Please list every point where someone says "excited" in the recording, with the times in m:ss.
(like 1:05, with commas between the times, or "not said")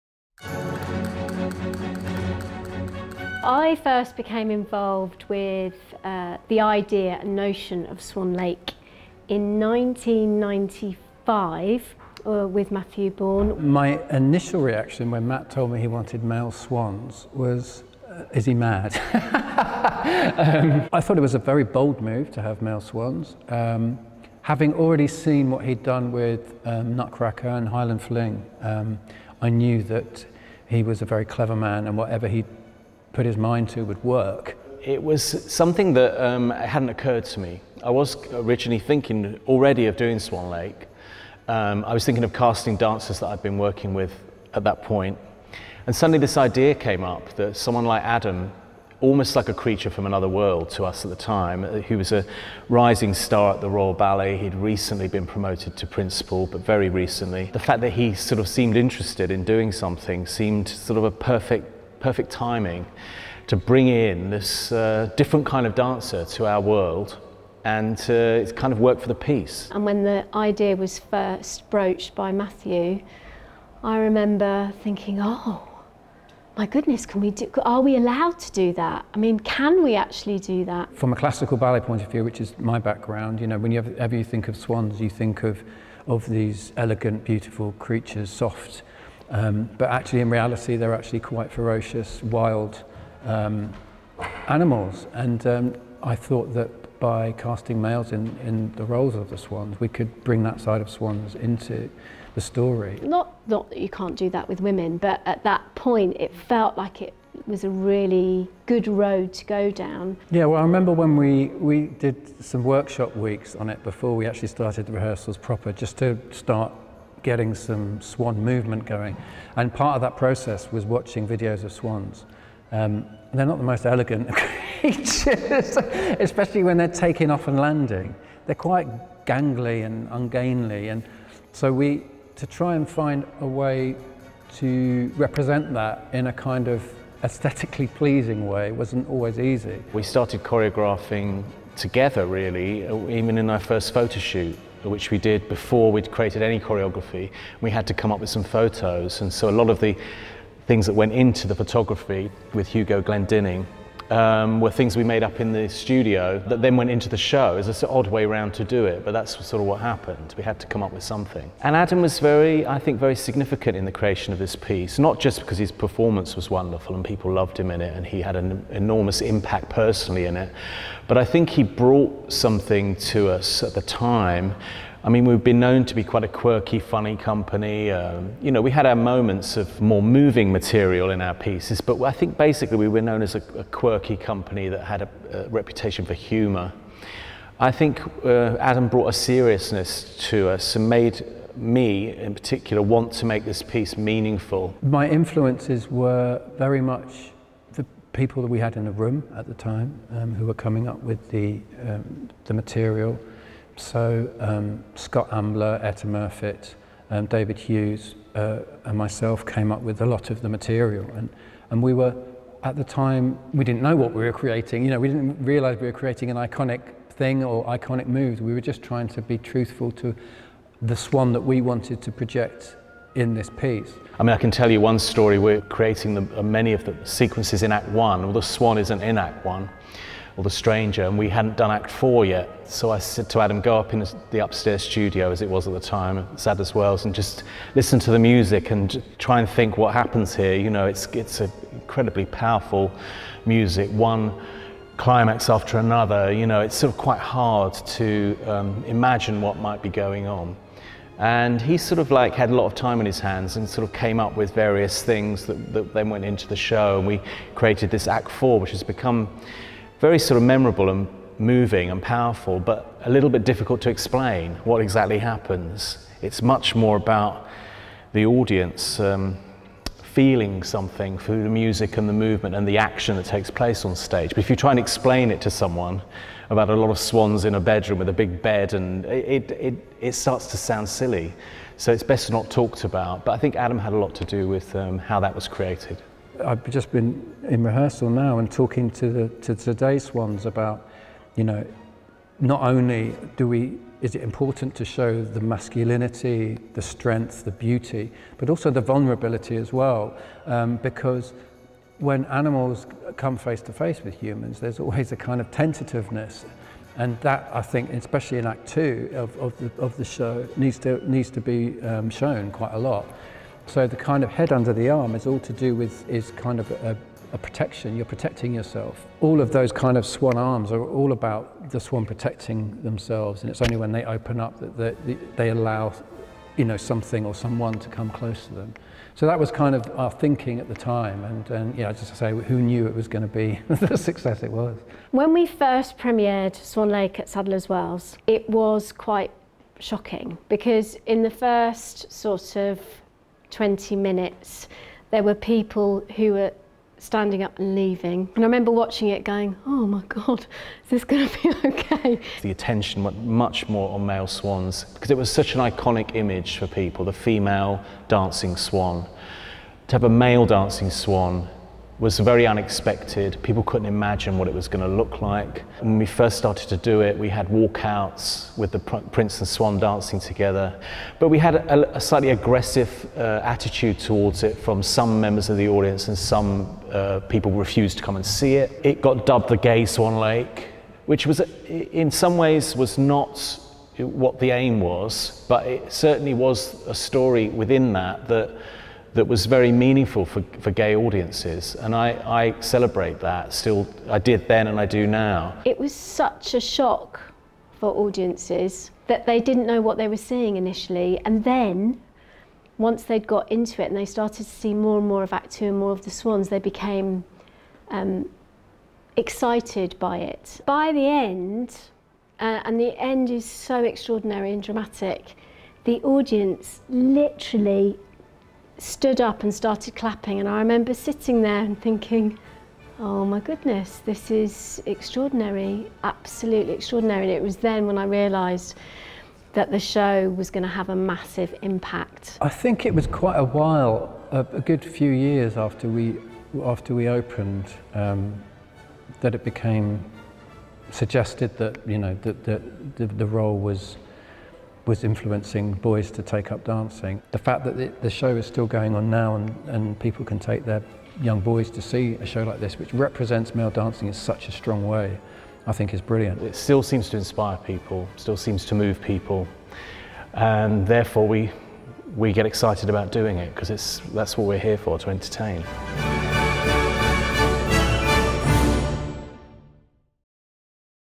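6:49, 7:42.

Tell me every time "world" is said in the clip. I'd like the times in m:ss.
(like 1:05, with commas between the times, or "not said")
0:50, 1:06.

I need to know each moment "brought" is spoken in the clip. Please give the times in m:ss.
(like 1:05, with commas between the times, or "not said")
2:51, 3:08.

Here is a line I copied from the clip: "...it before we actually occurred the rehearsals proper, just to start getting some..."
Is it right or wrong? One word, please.
wrong.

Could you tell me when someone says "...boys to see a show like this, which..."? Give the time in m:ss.
7:31.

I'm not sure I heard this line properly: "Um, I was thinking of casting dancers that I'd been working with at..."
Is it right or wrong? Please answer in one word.
right.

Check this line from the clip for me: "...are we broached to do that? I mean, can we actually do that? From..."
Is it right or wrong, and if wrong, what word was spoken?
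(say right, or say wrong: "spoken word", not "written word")
wrong: "allowed", not "broached".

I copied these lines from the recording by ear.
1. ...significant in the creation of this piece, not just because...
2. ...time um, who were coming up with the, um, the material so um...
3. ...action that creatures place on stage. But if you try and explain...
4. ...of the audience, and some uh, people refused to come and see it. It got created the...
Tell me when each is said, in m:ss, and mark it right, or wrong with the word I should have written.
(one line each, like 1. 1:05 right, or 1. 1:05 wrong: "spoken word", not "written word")
1. 2:43 right
2. 3:19 right
3. 4:32 wrong: "takes", not "creatures"
4. 6:15 wrong: "dubbed", not "created".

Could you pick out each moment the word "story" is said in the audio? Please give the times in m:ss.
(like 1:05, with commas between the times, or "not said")
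1:42, 3:44, 6:26.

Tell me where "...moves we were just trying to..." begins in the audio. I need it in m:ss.
3:38.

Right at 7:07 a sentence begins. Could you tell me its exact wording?
And it was then when I realised that the show was going to have a massive impact.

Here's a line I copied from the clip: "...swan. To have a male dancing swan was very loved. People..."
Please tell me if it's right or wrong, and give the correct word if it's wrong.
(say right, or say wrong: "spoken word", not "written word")
wrong: "unexpected", not "loved".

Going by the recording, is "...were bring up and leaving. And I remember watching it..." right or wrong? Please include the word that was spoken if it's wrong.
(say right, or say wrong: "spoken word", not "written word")
wrong: "standing", not "bring".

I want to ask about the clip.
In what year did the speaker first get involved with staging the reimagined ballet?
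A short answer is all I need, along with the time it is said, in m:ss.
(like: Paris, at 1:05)
1995, at 0:09.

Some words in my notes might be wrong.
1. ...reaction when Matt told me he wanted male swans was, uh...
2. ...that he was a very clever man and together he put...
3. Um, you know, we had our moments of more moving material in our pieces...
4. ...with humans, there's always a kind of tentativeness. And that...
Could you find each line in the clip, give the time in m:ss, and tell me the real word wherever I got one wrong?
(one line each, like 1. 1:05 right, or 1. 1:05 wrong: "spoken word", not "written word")
1. 0:14 right
2. 0:29 wrong: "whatever", not "together"
3. 2:57 right
4. 5:04 right.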